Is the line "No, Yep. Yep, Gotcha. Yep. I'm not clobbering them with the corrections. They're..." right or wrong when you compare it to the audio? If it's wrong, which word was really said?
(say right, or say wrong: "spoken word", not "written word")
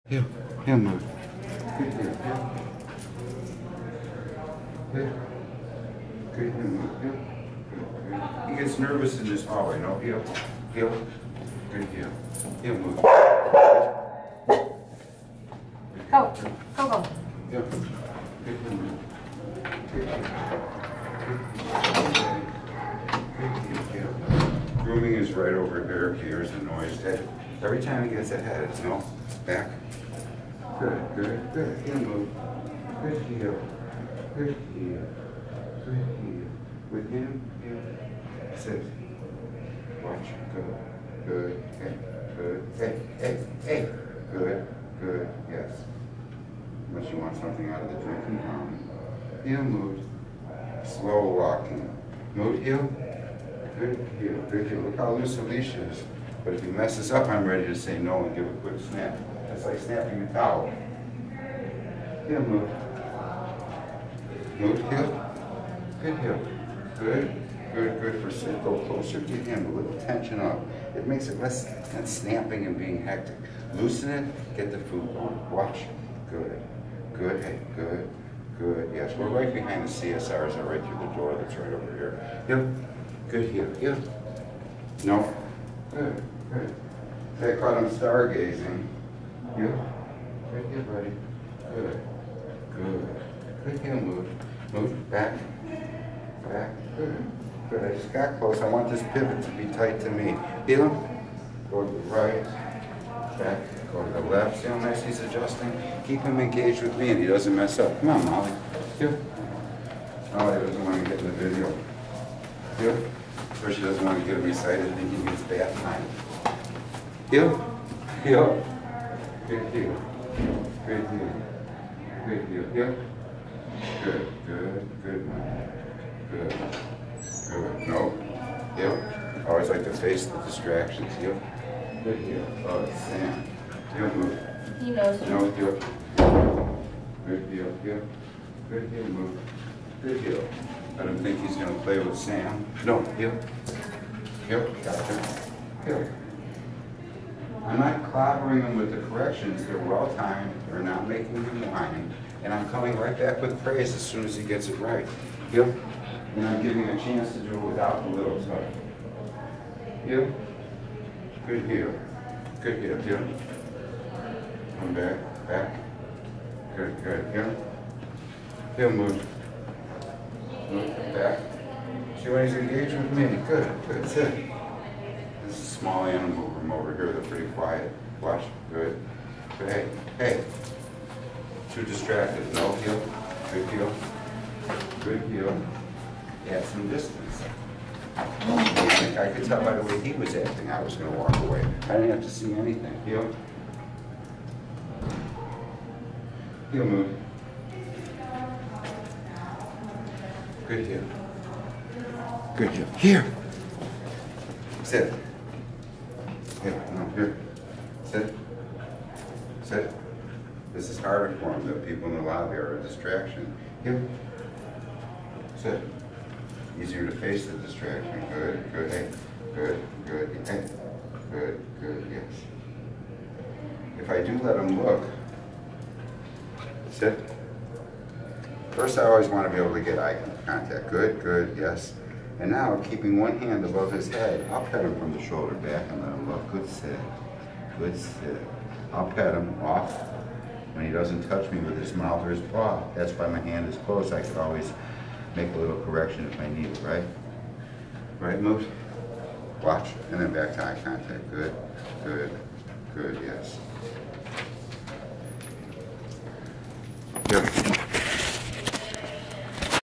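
right.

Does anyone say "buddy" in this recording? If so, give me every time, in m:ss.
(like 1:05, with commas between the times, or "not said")
1:30.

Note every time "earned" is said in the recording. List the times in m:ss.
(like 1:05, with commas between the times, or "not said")
not said.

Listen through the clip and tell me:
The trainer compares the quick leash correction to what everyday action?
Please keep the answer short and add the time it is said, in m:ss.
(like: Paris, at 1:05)
Snapping a towel, at 0:59.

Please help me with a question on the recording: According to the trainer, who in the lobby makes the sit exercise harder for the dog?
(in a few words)
The people.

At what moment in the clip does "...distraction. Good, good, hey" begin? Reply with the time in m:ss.
3:37.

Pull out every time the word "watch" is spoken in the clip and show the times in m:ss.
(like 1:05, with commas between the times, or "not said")
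0:40, 1:15, 2:58, 4:09.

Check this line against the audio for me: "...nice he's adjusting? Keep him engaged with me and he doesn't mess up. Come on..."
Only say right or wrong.
right.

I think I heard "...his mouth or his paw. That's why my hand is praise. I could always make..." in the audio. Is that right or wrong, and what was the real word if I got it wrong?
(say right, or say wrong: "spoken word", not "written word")
wrong: "close", not "praise".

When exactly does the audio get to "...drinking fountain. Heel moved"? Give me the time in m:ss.
0:48.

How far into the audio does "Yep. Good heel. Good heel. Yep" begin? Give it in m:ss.
2:40.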